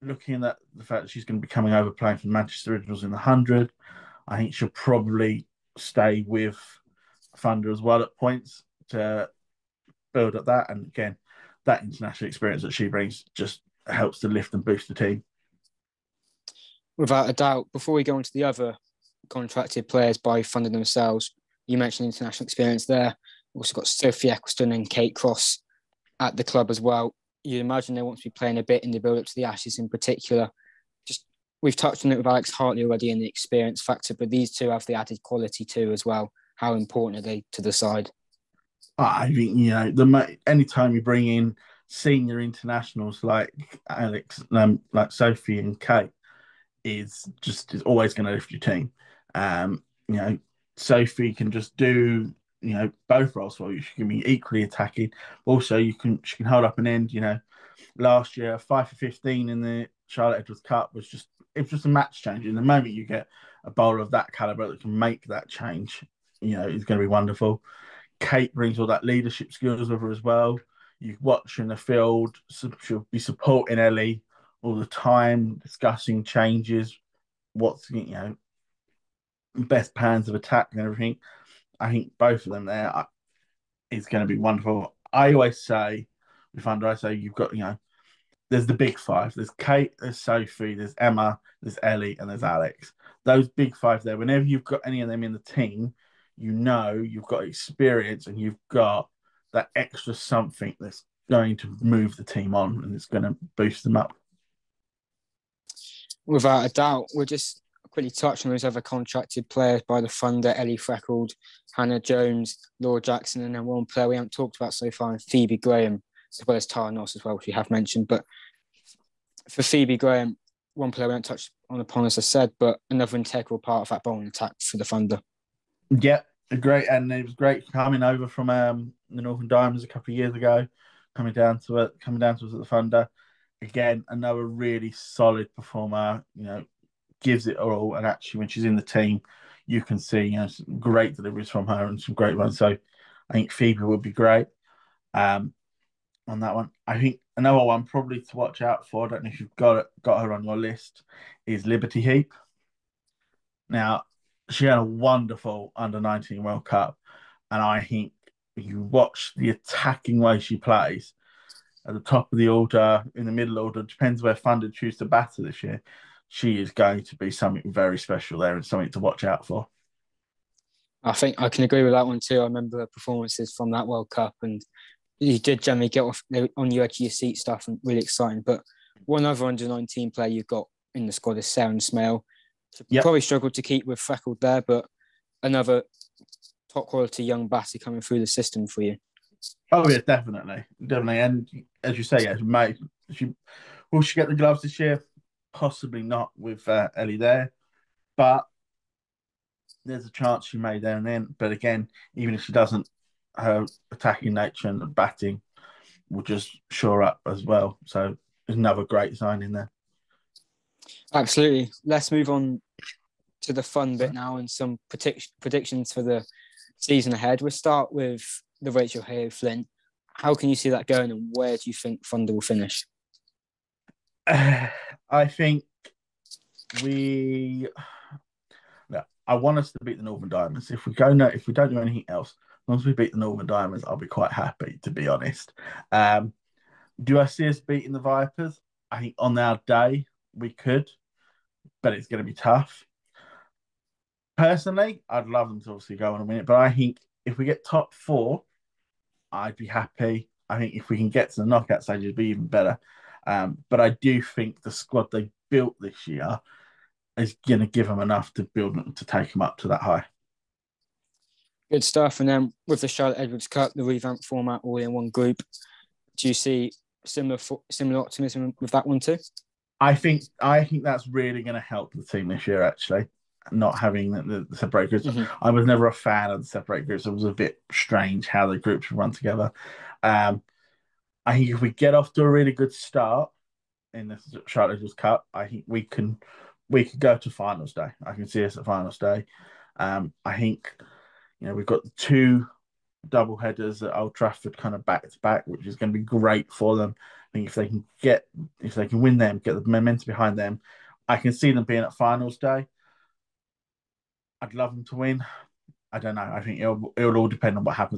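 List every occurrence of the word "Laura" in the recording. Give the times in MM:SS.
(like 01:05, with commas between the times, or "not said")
01:52.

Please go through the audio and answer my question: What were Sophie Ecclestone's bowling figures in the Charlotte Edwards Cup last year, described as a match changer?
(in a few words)
5 for 15.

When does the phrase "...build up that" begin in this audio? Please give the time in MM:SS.
00:10.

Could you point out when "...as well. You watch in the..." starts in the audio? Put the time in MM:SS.
01:10.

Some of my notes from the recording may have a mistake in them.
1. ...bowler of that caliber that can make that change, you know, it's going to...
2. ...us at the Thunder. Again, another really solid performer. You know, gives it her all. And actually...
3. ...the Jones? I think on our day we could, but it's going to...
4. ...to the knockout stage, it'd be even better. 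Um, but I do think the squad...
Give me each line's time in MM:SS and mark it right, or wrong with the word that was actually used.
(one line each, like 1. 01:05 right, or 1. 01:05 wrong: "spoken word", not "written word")
1. 01:03 right
2. 02:12 right
3. 03:57 wrong: "Vipers", not "Jones"
4. 04:11 right.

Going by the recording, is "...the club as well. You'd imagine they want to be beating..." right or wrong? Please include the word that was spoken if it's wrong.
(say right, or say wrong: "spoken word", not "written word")
wrong: "playing", not "beating".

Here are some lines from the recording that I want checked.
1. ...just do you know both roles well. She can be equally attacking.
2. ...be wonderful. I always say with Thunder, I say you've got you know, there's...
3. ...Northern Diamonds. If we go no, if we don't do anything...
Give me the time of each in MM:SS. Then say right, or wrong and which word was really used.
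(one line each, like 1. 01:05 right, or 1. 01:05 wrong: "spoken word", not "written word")
1. 00:51 right
2. 01:24 right
3. 03:50 right.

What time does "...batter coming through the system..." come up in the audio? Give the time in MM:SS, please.
03:07.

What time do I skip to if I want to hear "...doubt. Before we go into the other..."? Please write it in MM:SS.
00:17.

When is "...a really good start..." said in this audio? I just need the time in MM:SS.
04:42.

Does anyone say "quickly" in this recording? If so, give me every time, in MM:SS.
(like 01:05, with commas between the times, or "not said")
01:47.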